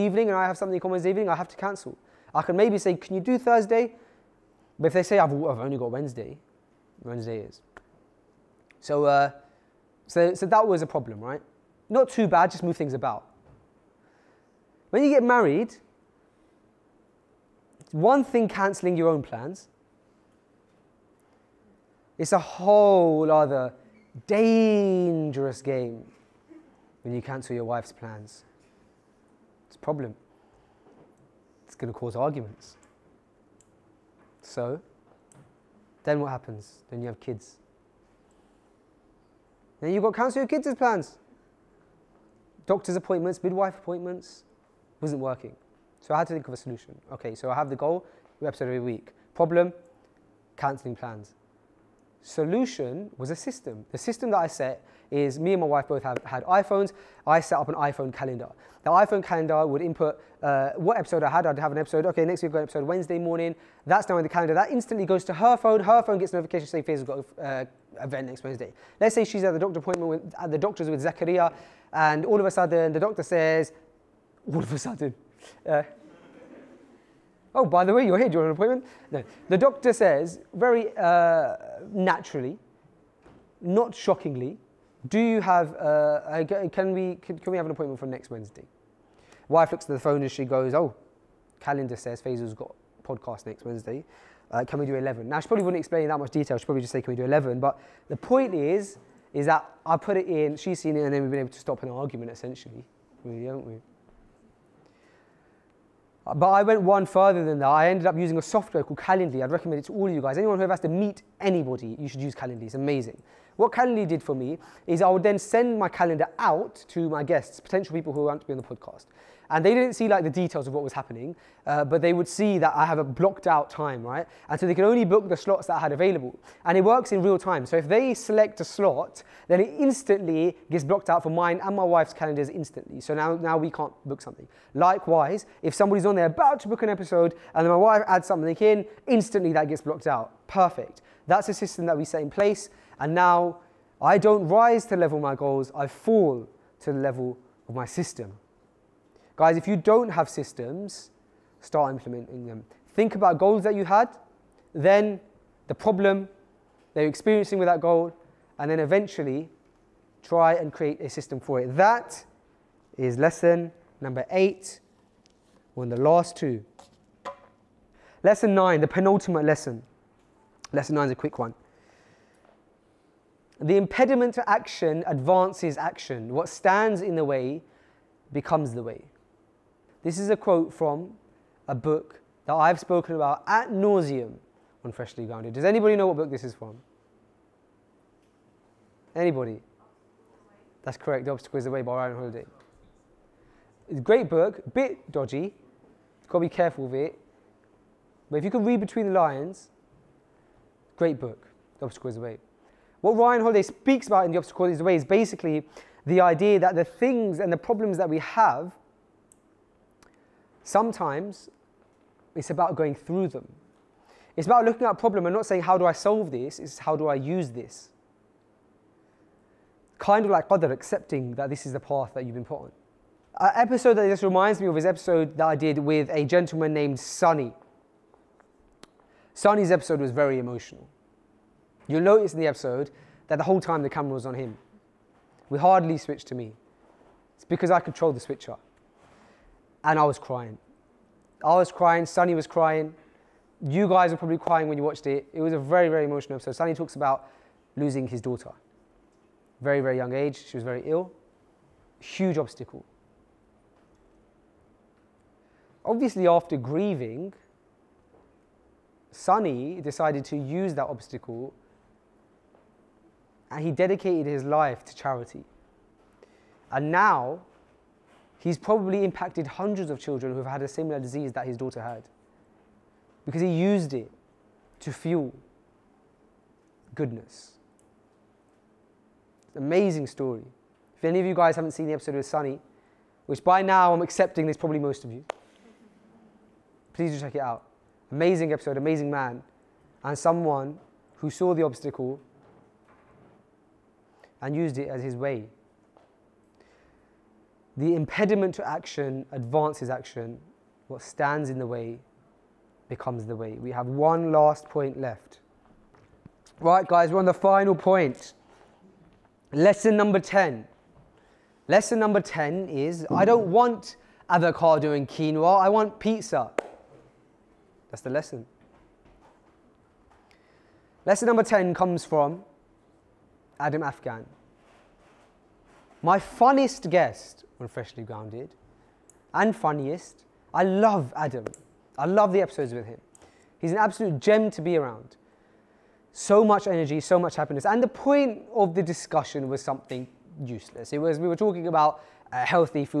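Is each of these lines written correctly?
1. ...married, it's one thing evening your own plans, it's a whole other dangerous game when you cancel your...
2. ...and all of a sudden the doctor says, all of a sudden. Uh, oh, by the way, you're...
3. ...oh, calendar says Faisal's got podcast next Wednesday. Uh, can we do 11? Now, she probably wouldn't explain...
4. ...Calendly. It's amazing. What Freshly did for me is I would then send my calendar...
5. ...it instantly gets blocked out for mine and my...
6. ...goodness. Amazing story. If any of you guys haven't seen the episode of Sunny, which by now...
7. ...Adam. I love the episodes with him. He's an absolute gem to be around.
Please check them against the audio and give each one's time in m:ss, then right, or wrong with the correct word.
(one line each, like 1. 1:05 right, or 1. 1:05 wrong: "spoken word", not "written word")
1. 0:15 wrong: "cancelling", not "evening"
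2. 1:11 right
3. 1:30 right
4. 1:52 wrong: "Calendly", not "Freshly"
5. 2:09 right
6. 4:36 right
7. 5:31 right.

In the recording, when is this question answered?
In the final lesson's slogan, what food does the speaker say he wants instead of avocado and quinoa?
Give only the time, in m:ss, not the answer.
5:15.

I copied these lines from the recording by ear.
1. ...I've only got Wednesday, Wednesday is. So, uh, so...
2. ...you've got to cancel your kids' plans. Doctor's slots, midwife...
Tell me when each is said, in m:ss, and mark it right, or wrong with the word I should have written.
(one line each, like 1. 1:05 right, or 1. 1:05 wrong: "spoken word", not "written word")
1. 0:05 right
2. 0:39 wrong: "appointments", not "slots".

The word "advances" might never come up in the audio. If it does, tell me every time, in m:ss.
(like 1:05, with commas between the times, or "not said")
2:55, 4:59.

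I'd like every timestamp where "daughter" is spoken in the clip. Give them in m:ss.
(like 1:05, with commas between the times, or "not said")
4:08, 4:31.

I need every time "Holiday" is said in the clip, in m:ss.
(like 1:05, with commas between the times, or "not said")
3:12, 3:23.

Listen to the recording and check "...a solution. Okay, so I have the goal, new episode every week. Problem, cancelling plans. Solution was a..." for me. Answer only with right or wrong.
right.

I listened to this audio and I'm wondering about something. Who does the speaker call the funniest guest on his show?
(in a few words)
Adam Afghan.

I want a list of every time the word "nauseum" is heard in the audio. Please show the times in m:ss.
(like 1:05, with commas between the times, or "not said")
3:03.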